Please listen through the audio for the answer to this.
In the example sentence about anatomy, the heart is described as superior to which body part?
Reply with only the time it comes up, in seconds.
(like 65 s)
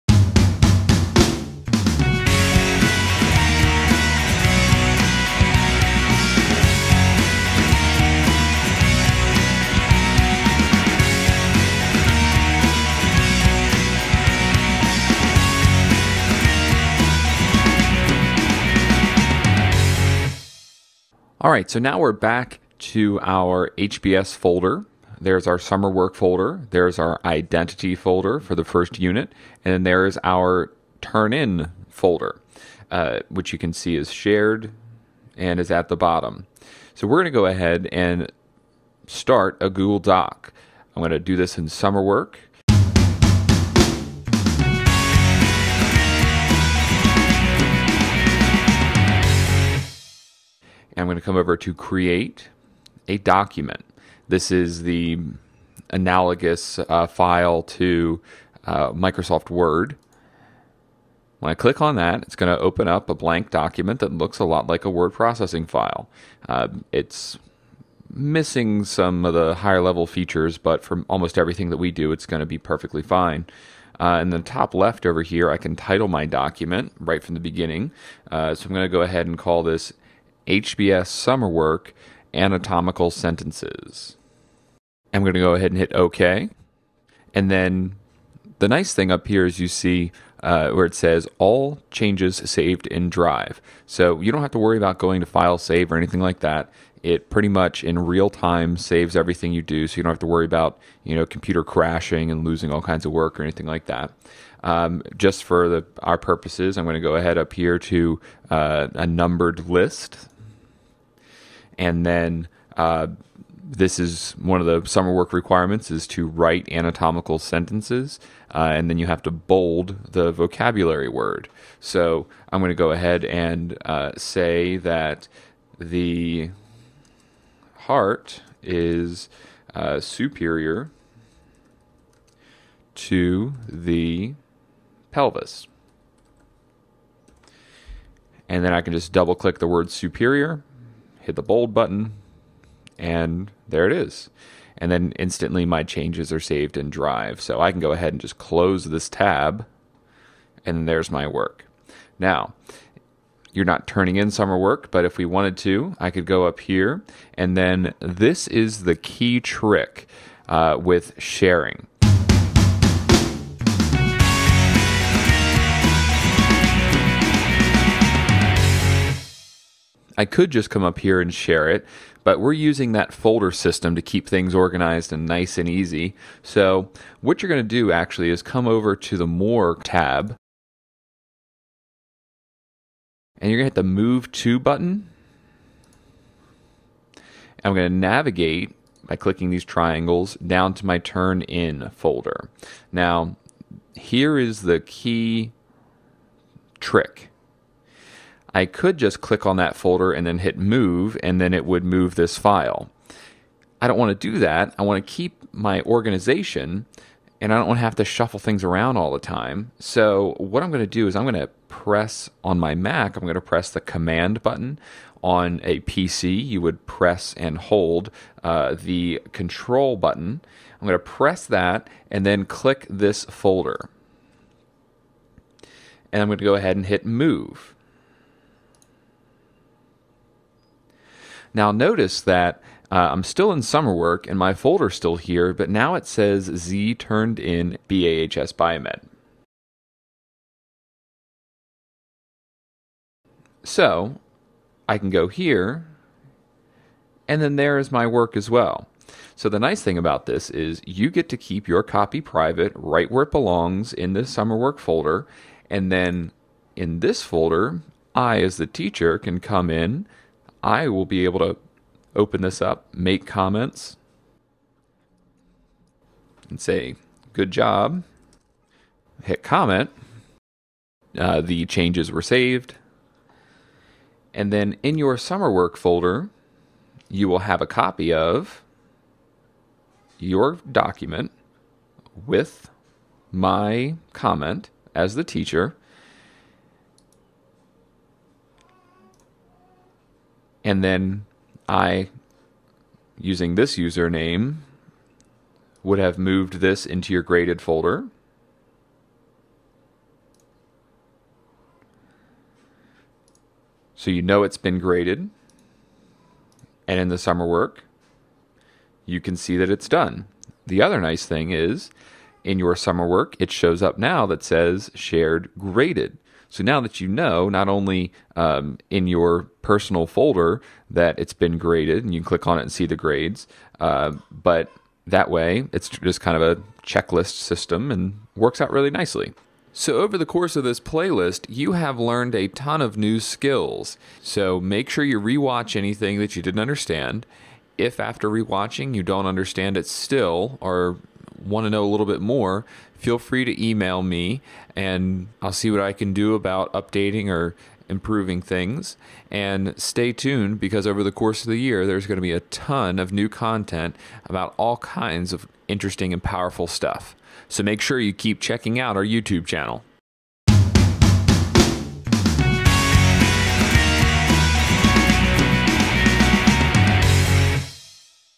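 133 s.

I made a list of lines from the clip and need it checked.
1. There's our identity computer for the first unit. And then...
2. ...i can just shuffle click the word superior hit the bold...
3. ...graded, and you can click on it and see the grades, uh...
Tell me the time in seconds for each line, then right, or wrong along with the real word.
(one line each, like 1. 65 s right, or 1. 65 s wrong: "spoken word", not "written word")
1. 26 s wrong: "folder", not "computer"
2. 138 s wrong: "double", not "shuffle"
3. 321 s right.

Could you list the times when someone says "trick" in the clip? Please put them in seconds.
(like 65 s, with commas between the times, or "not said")
159 s, 196 s.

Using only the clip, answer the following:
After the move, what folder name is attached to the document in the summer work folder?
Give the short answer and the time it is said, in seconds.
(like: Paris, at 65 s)
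Z turned in BAHS Biomed, at 236 s.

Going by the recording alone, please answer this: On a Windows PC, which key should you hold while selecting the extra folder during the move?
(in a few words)
control.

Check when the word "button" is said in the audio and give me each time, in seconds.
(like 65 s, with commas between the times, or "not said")
141 s, 184 s, 214 s, 219 s.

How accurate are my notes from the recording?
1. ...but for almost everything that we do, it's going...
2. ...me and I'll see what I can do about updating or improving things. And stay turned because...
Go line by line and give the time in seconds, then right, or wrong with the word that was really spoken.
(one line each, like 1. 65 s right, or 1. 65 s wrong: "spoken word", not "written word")
1. 70 s right
2. 344 s wrong: "tuned", not "turned".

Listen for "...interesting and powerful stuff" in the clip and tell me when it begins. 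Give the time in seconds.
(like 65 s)
355 s.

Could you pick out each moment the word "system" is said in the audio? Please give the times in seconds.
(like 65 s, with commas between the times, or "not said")
173 s, 327 s.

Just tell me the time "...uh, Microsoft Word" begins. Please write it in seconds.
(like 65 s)
58 s.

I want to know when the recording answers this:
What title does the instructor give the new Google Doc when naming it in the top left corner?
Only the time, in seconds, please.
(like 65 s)
80 s.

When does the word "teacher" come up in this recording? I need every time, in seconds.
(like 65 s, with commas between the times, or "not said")
258 s, 285 s.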